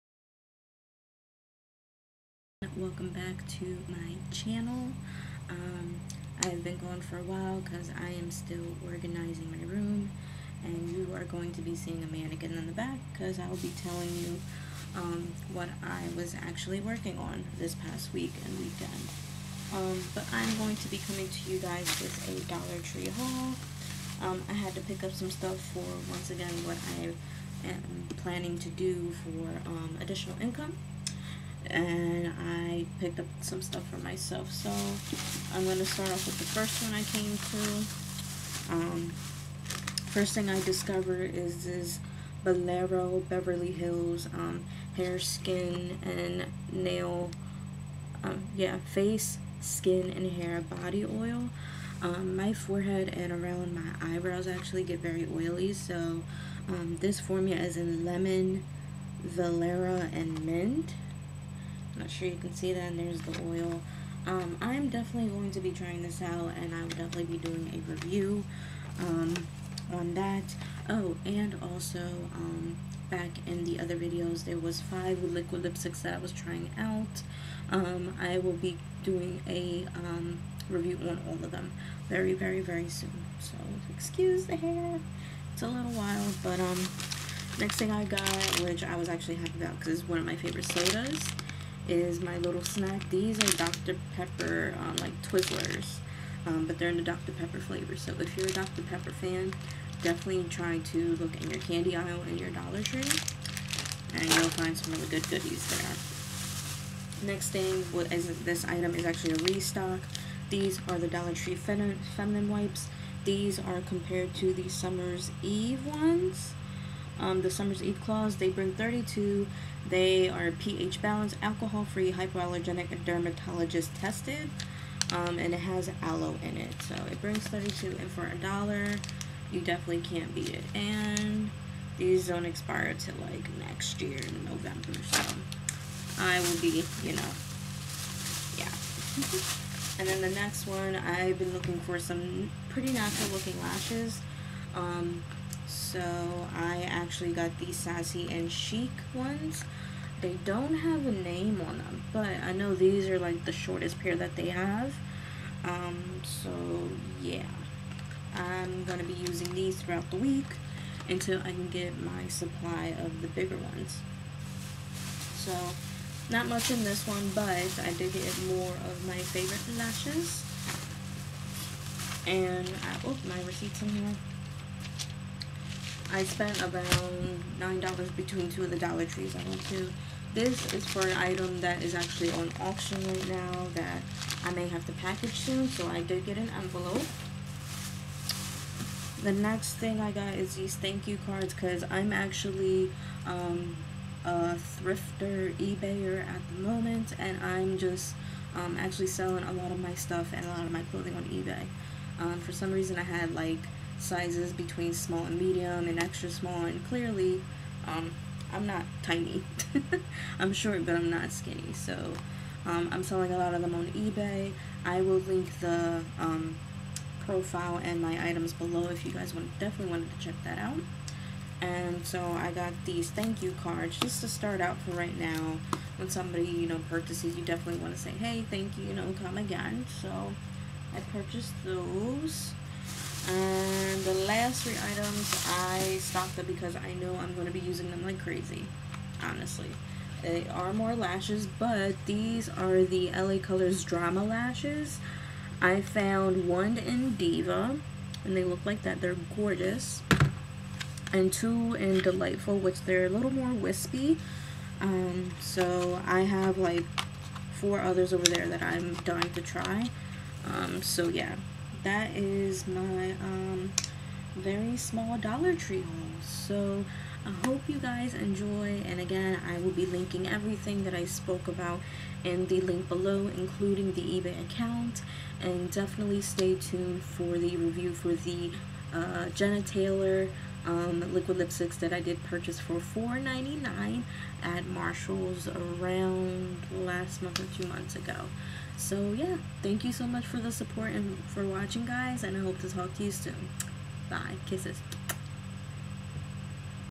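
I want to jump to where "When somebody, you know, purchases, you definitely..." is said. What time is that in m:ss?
3:45.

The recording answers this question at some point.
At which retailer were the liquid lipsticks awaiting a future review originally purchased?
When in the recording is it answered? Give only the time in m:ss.
4:44.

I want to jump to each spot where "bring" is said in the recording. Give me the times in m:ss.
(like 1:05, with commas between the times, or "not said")
1:58, 2:07.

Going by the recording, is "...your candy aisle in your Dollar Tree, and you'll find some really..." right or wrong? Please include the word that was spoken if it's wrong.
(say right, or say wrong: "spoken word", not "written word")
right.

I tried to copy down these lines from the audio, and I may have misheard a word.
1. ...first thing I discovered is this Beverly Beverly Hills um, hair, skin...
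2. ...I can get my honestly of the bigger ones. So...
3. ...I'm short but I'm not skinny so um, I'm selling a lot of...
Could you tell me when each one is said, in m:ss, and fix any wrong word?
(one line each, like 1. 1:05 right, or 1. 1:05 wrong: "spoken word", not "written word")
1. 0:40 wrong: "Bolero", not "Beverly"
2. 2:41 wrong: "supply", not "honestly"
3. 3:30 right.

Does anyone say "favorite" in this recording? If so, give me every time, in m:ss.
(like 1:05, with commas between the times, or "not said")
1:30, 2:49.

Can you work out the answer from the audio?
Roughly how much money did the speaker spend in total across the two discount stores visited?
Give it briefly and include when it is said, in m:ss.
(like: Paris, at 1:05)
$9, at 2:57.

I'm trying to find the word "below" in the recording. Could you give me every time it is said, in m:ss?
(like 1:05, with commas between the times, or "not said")
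3:38, 4:32.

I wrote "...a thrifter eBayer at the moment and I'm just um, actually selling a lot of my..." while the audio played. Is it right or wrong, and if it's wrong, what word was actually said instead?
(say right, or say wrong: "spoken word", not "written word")
right.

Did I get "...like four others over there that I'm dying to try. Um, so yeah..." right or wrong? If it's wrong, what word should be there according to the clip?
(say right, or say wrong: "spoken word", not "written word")
right.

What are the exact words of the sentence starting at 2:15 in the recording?
So I will be, you know, yeah.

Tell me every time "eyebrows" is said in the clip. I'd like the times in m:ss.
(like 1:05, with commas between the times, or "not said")
0:54.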